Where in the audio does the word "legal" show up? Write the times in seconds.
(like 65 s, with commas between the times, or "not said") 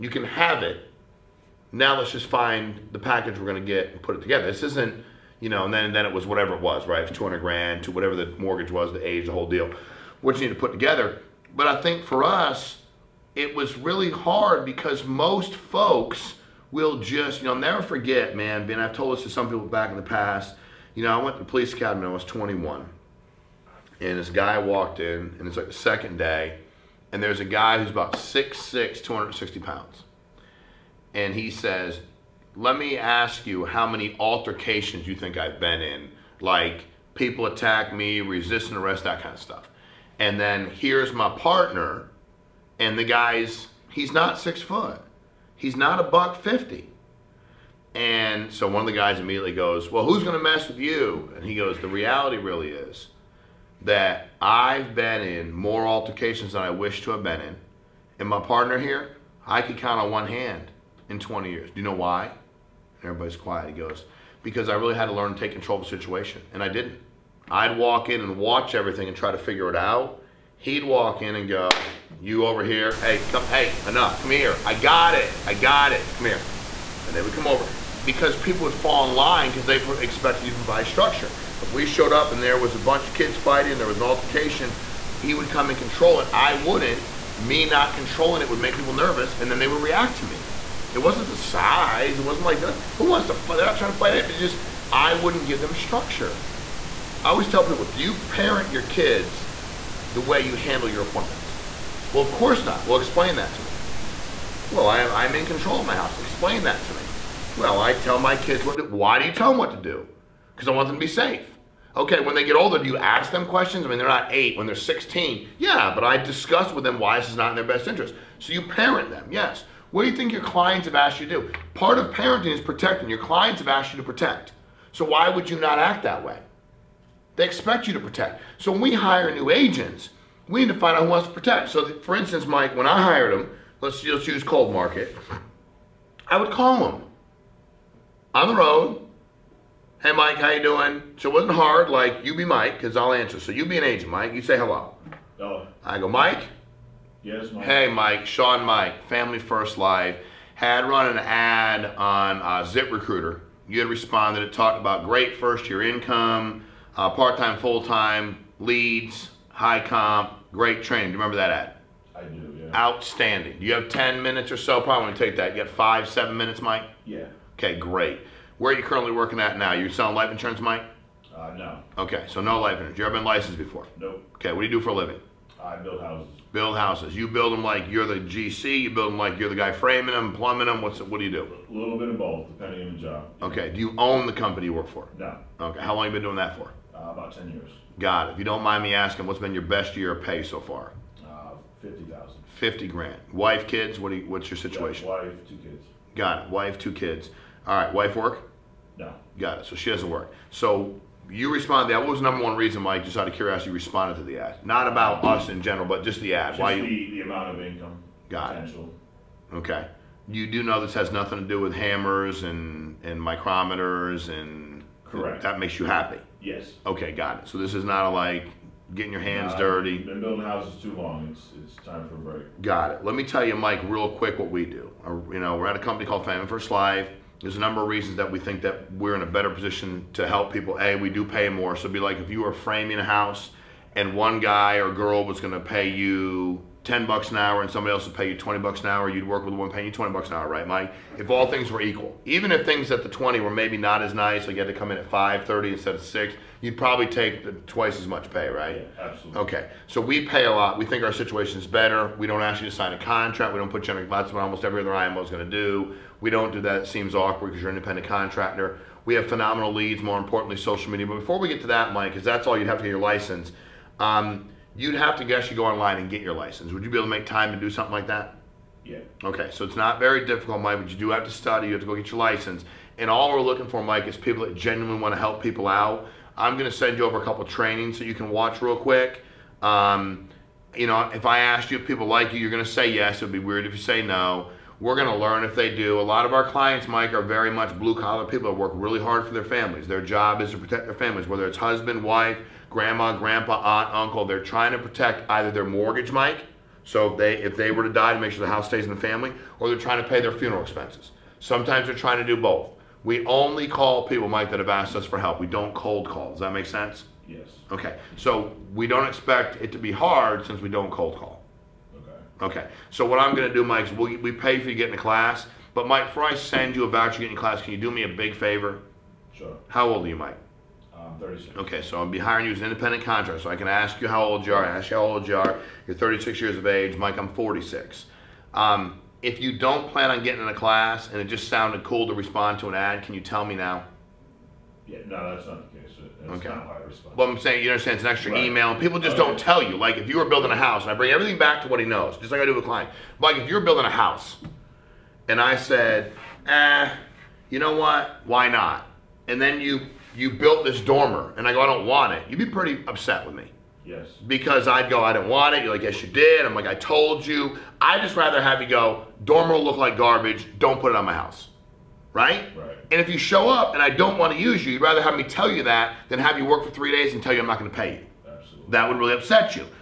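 not said.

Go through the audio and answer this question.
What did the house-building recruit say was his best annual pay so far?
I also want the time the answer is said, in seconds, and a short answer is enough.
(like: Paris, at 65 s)
50,000, at 191 s.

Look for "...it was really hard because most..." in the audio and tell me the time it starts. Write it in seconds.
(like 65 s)
13 s.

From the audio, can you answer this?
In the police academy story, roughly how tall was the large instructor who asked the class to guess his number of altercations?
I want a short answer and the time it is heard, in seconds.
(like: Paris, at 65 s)
6'6, at 28 s.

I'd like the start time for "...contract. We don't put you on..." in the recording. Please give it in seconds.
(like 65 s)
252 s.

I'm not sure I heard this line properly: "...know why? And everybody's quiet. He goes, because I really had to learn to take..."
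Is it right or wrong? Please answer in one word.
right.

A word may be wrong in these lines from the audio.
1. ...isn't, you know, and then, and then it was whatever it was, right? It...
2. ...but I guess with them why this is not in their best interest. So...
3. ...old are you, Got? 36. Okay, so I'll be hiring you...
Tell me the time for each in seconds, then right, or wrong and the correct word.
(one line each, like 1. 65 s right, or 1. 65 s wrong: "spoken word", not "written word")
1. 4 s right
2. 115 s wrong: "discuss", not "guess"
3. 319 s wrong: "Mike", not "Got".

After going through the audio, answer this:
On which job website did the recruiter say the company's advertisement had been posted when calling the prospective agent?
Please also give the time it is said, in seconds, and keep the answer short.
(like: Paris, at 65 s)
ZipRecruiter, at 152 s.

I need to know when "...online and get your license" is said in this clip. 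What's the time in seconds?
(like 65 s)
265 s.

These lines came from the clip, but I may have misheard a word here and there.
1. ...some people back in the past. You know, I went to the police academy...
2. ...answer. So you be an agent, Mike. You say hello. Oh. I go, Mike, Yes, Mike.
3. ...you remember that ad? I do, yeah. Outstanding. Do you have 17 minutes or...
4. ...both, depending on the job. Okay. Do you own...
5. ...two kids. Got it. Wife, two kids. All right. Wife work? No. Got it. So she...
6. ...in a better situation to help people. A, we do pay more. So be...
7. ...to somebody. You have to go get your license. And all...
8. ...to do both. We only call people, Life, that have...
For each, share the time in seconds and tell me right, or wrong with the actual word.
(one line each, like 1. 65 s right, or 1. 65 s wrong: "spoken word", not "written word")
1. 19 s right
2. 143 s right
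3. 161 s wrong: "10", not "17"
4. 182 s right
5. 195 s right
6. 229 s wrong: "position", not "situation"
7. 271 s wrong: "study", not "somebody"
8. 302 s wrong: "Mike", not "Life".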